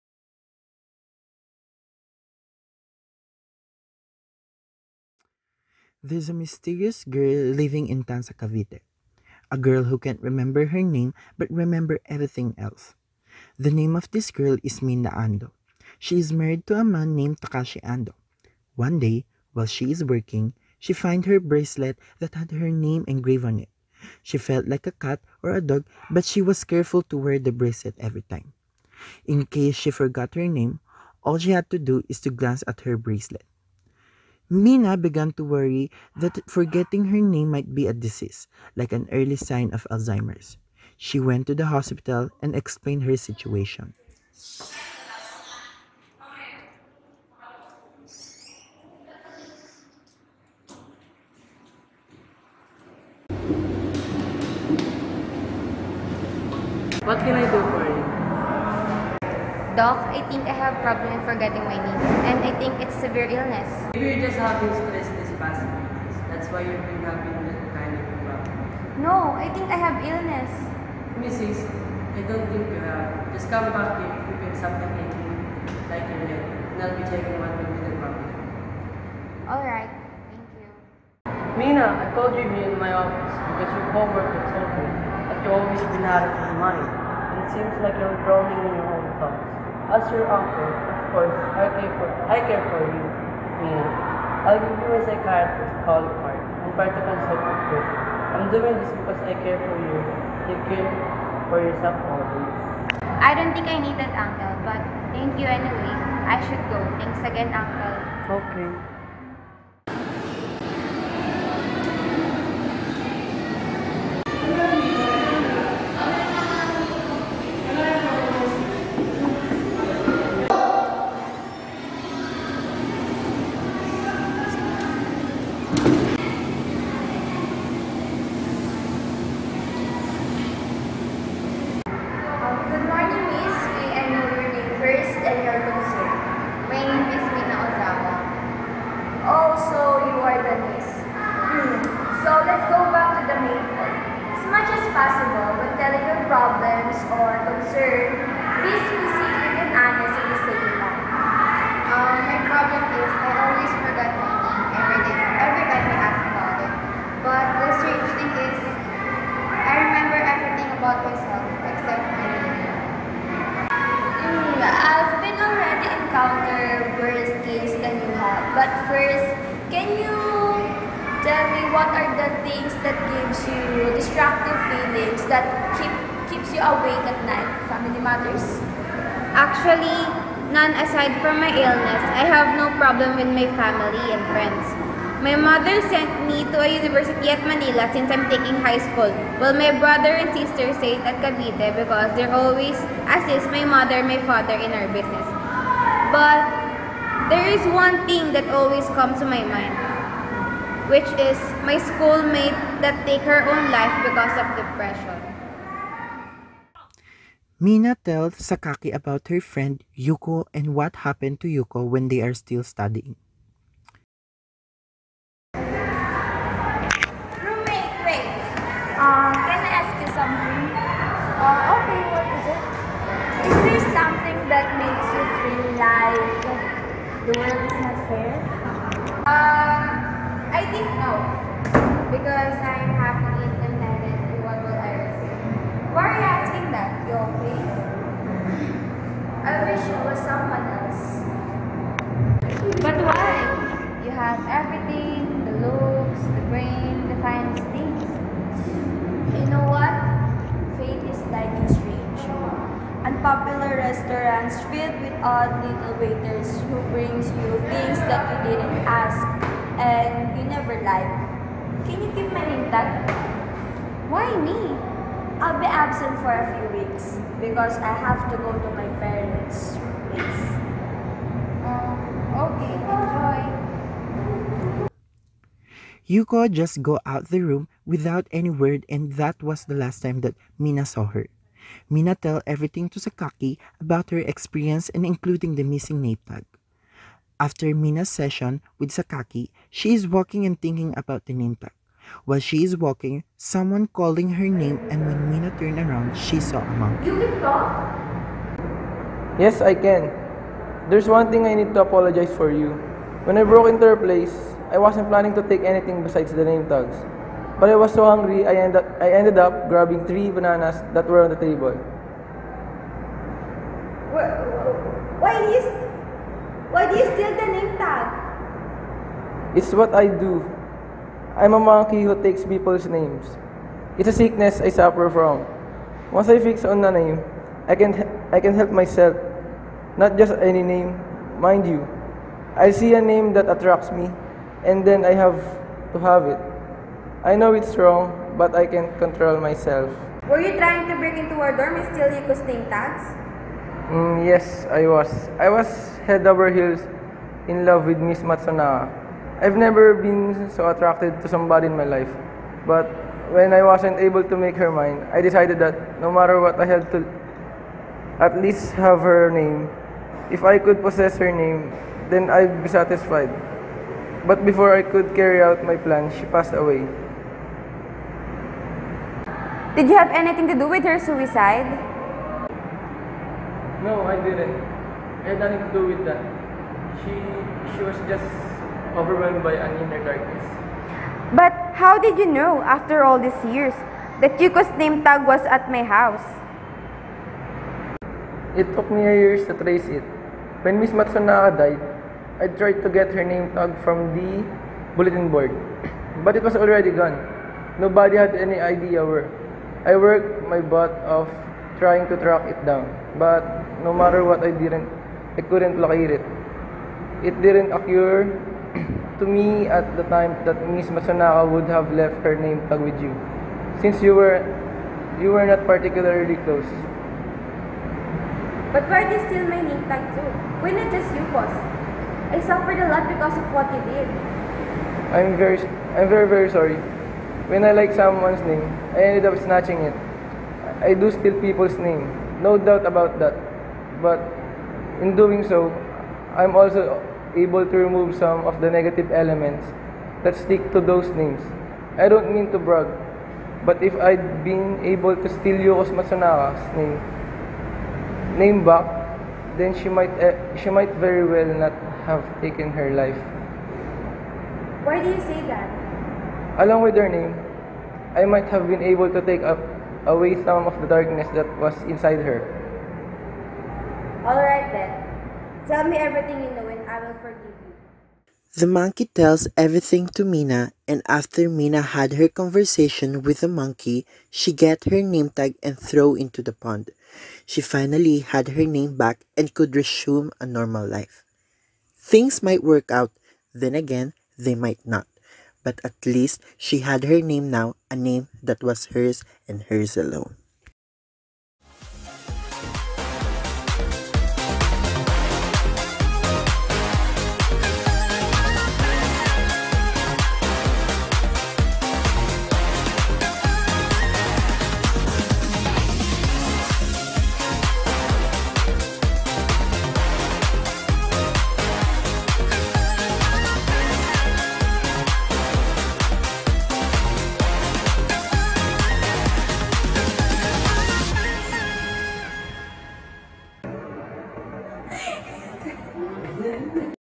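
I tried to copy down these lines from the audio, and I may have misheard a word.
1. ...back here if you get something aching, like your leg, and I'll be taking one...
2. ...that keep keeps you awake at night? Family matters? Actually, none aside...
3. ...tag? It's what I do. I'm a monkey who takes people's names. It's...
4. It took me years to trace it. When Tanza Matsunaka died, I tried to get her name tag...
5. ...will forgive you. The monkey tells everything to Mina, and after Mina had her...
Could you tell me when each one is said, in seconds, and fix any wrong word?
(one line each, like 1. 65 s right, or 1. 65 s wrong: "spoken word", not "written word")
1. 73 s right
2. 175 s right
3. 317 s right
4. 388 s wrong: "Miss", not "Tanza"
5. 467 s right.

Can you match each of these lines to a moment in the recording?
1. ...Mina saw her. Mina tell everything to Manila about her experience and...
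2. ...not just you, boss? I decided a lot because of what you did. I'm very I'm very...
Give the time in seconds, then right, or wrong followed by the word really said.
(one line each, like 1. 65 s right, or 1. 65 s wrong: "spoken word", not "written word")
1. 280 s wrong: "Sakaki", not "Manila"
2. 420 s wrong: "suffered", not "decided".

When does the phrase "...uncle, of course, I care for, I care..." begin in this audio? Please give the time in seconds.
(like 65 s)
90 s.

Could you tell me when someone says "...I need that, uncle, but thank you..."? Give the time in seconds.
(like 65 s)
103 s.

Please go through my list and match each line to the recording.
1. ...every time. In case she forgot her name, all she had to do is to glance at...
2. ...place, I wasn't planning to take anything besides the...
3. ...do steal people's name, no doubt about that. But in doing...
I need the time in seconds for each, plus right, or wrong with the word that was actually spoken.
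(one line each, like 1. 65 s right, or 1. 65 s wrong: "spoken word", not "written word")
1. 28 s right
2. 303 s right
3. 430 s right.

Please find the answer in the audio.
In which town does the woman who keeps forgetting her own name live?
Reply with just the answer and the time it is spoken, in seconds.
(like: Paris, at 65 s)
Tanza, Cavite, at 8 s.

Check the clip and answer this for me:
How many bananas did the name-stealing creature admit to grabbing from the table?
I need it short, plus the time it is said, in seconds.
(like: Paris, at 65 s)
3, at 310 s.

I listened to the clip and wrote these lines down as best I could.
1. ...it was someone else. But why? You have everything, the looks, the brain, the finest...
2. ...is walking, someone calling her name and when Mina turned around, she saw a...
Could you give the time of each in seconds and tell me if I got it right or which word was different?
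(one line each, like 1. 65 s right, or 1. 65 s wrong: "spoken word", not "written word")
1. 239 s right
2. 292 s right.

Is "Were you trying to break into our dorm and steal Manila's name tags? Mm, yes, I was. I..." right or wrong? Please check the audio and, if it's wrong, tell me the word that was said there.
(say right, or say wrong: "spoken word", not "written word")
wrong: "Yuko", not "Manila".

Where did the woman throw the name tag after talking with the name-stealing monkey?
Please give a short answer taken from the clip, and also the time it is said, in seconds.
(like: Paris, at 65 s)
Into the pond, at 476 s.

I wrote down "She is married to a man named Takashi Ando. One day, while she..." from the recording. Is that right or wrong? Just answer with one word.
right.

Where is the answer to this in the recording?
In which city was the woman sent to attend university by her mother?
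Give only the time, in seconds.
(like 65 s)
187 s.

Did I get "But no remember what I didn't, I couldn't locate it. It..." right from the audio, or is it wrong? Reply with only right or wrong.
wrong.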